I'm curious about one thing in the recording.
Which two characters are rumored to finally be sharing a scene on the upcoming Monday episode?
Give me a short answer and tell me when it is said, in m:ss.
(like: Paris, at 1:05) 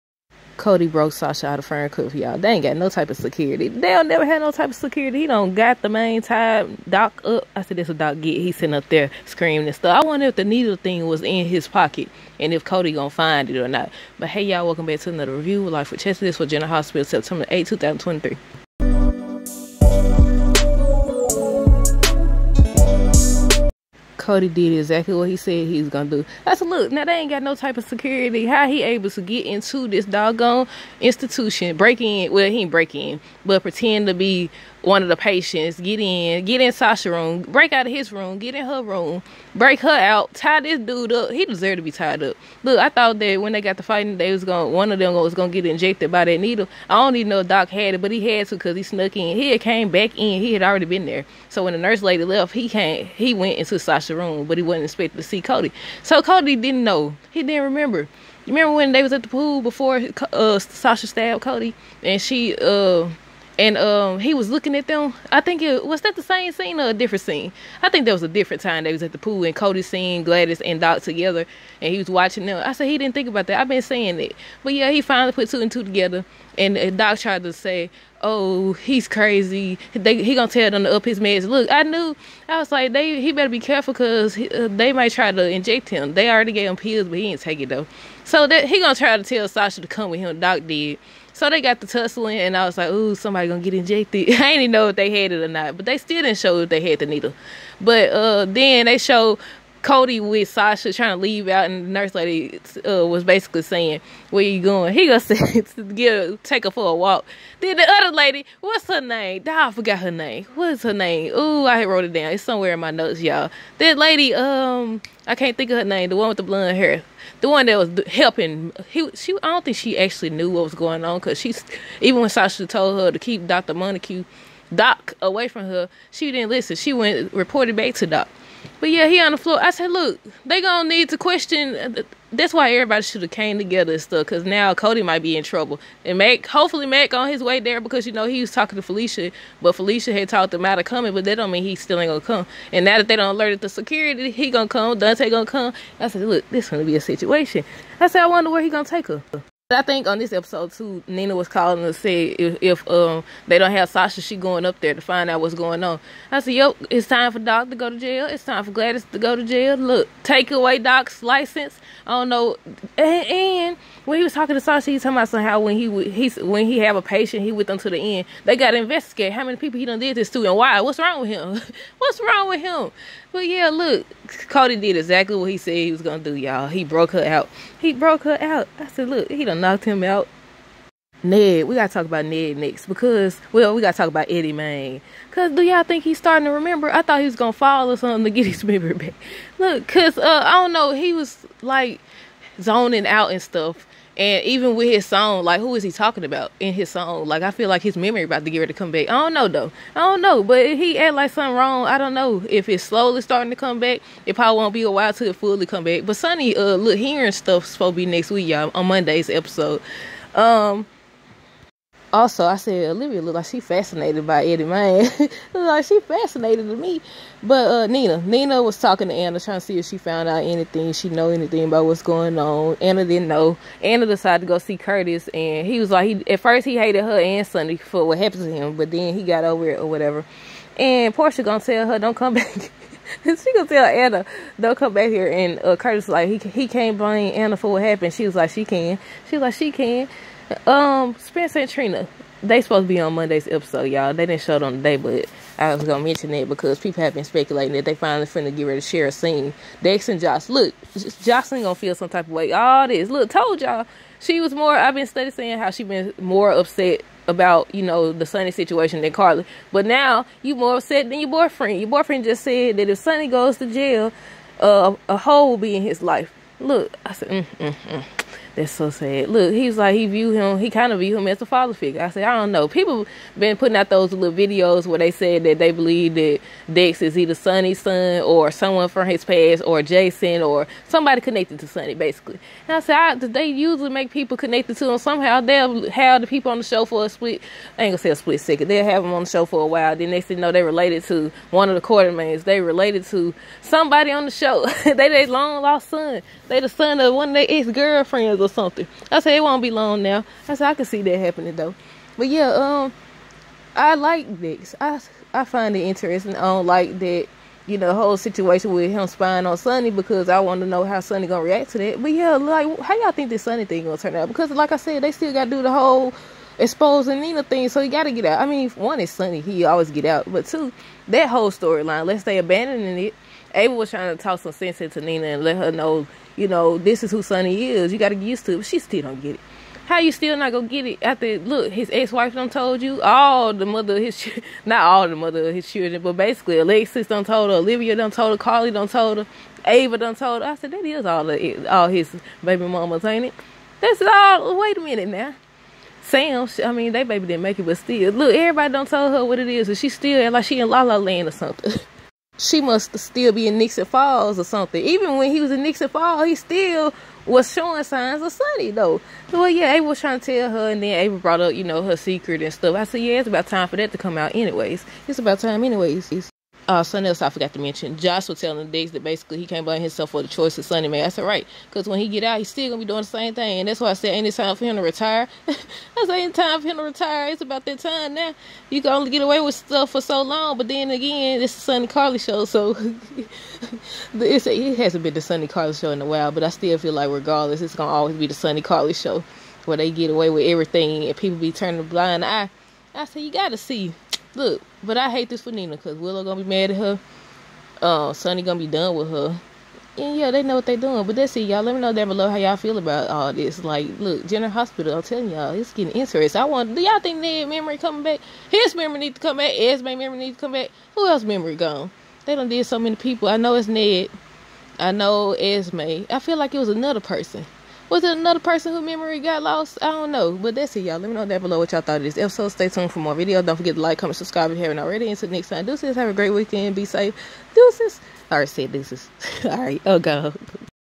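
Spencer and Trina, at 4:01.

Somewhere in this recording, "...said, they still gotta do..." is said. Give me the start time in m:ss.
5:14.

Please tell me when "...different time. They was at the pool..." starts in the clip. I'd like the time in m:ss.
1:08.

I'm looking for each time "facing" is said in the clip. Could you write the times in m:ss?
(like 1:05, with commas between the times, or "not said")
not said.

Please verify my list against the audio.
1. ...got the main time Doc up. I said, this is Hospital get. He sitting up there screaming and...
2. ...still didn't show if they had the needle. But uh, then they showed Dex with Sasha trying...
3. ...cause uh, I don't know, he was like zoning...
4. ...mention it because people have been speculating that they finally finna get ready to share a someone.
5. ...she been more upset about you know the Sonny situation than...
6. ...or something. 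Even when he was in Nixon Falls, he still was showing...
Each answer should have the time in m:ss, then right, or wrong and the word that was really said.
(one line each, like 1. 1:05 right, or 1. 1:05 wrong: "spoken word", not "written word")
1. 0:05 wrong: "Doc", not "Hospital"
2. 1:35 wrong: "Cody", not "Dex"
3. 3:09 right
4. 4:06 wrong: "scene", not "someone"
5. 4:15 right
6. 5:54 right.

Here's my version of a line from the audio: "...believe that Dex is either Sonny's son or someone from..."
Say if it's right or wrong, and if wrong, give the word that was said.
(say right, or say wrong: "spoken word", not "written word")
right.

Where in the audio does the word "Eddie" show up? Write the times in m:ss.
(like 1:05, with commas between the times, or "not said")
3:04, 3:34.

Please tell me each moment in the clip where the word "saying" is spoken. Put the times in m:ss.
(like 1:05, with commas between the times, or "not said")
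1:13, 1:43, 4:15.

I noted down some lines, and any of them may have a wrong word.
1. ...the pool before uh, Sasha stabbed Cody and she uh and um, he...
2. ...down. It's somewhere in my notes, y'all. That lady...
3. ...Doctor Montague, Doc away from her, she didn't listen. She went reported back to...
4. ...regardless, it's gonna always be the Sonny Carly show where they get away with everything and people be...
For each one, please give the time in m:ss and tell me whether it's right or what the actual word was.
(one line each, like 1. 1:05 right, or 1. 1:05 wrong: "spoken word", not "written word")
1. 0:59 right
2. 1:52 right
3. 2:03 right
4. 6:27 right.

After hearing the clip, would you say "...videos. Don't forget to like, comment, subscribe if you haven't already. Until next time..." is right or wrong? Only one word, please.
right.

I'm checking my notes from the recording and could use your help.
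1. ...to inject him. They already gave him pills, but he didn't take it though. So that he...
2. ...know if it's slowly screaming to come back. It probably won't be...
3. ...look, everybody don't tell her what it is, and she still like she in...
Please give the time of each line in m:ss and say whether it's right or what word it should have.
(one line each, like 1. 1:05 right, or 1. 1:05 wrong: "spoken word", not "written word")
1. 1:25 right
2. 3:22 wrong: "starting", not "screaming"
3. 5:48 right.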